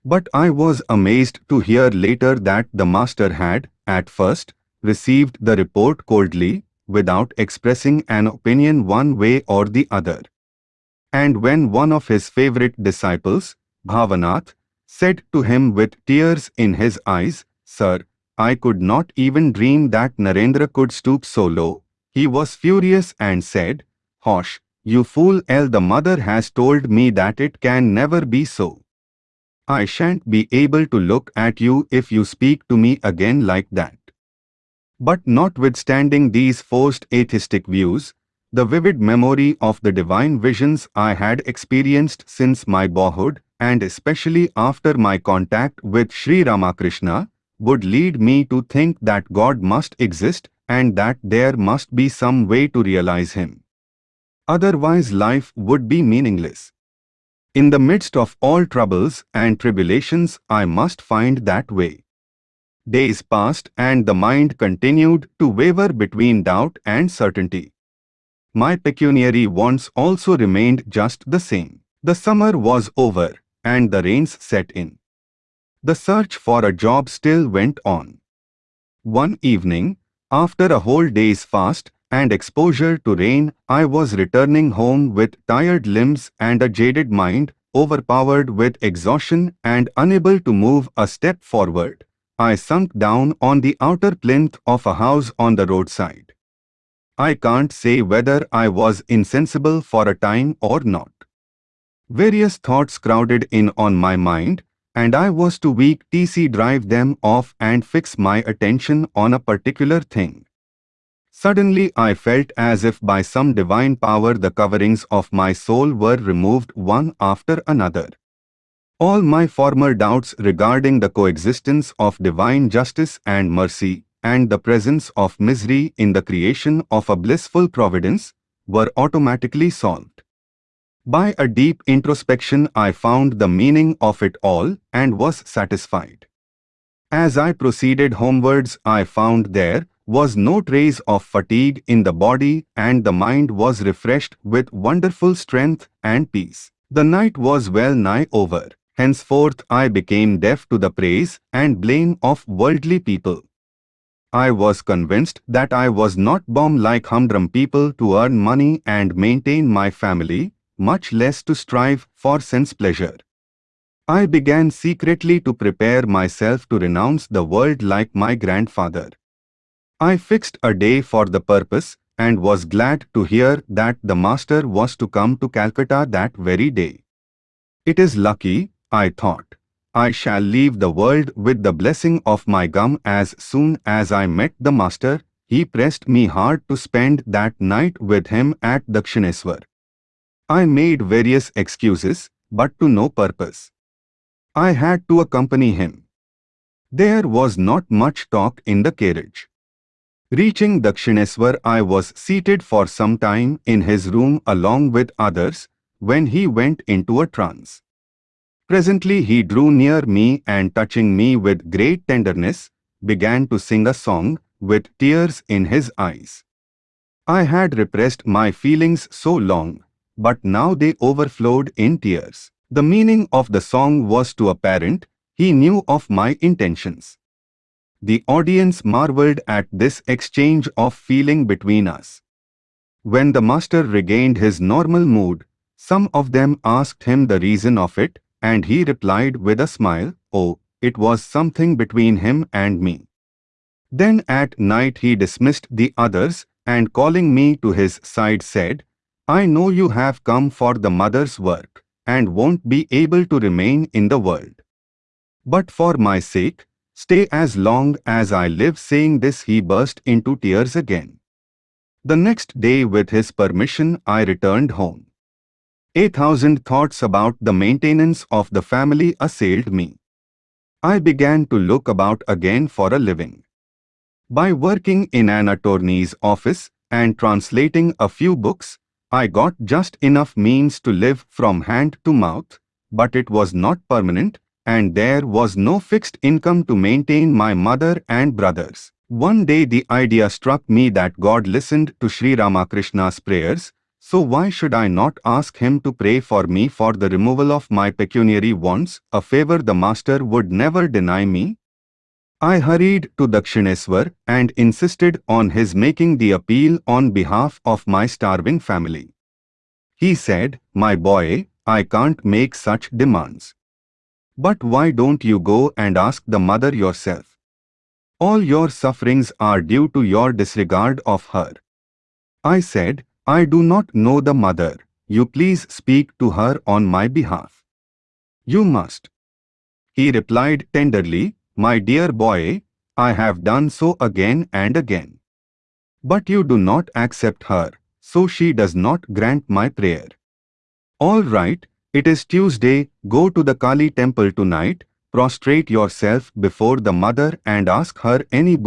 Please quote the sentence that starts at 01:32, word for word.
I sunk down on the outer plinth of a house on the roadside.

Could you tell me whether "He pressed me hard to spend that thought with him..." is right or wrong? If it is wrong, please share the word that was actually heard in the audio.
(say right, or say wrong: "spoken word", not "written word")
wrong: "night", not "thought".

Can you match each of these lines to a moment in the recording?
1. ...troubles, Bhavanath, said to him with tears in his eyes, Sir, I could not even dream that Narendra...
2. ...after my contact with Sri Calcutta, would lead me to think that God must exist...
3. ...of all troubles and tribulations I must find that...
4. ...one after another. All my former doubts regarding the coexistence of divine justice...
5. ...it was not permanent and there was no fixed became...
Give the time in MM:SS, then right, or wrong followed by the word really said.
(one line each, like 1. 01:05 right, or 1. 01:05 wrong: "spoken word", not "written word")
1. 00:12 wrong: "disciples", not "troubles"
2. 00:44 wrong: "Ramakrishna", not "Calcutta"
3. 00:58 right
4. 01:56 right
5. 04:43 wrong: "income", not "became".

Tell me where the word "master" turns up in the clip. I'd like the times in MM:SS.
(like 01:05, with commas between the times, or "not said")
00:02, 02:54, 03:04, 03:53, 04:59.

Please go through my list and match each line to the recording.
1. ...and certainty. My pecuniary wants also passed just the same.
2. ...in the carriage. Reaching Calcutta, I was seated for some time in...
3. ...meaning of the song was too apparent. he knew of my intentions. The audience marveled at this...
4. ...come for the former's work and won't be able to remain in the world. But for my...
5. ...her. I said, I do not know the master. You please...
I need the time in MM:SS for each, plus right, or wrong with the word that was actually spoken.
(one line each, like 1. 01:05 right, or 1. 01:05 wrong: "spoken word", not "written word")
1. 01:06 wrong: "remained", not "passed"
2. 03:18 wrong: "Dakshineswar", not "Calcutta"
3. 03:42 right
4. 04:10 wrong: "mother", not "former"
5. 05:21 wrong: "mother", not "master".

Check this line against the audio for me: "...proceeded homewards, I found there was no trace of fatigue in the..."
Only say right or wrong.
right.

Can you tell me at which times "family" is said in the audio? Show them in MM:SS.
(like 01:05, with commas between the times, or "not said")
02:39, 04:28, 05:08.